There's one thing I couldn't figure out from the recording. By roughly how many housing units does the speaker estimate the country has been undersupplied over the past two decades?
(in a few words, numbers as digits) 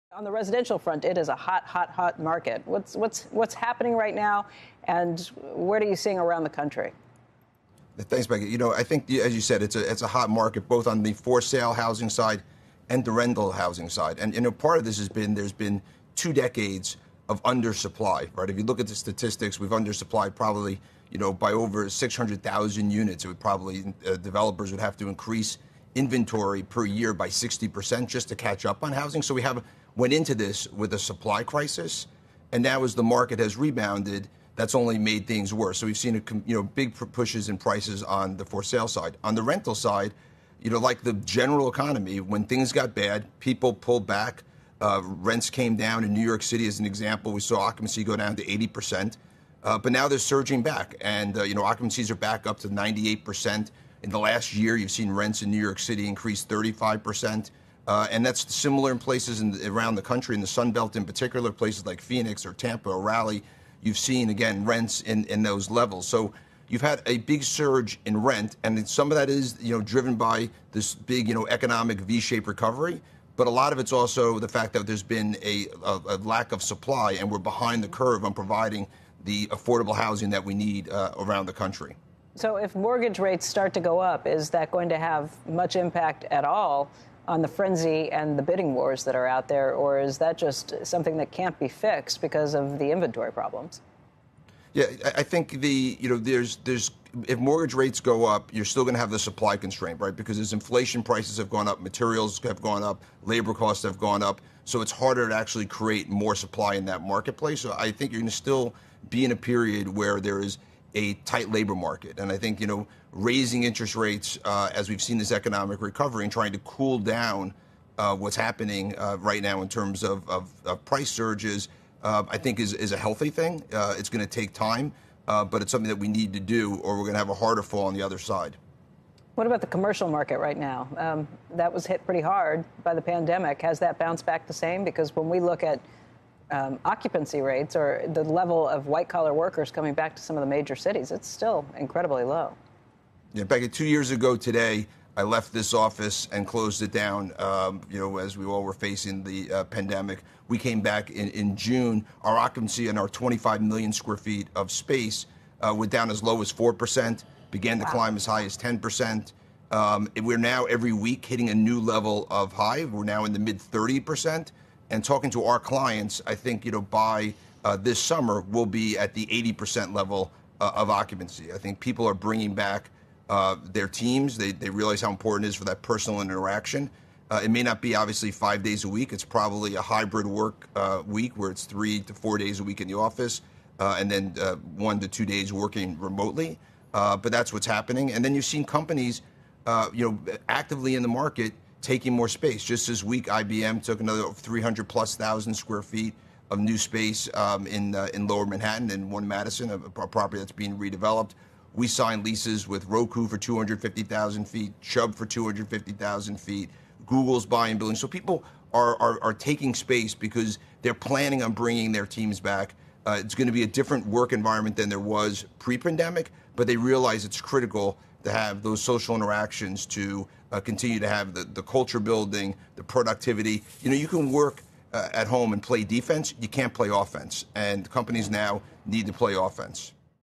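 over 600,000.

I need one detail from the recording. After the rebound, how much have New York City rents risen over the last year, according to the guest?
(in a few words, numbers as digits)
35%.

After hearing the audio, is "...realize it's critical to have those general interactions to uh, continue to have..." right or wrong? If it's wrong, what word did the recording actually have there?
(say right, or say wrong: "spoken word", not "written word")
wrong: "social", not "general".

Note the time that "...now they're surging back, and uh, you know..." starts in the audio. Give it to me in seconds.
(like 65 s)
49 s.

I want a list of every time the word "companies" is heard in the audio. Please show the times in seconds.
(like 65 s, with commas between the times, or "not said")
188 s, 227 s.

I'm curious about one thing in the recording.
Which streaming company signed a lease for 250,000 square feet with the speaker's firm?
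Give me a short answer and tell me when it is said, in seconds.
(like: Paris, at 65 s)
Roku, at 202 s.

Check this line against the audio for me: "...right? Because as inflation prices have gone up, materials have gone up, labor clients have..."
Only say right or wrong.
wrong.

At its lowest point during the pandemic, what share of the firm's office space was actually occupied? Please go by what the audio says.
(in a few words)
4%.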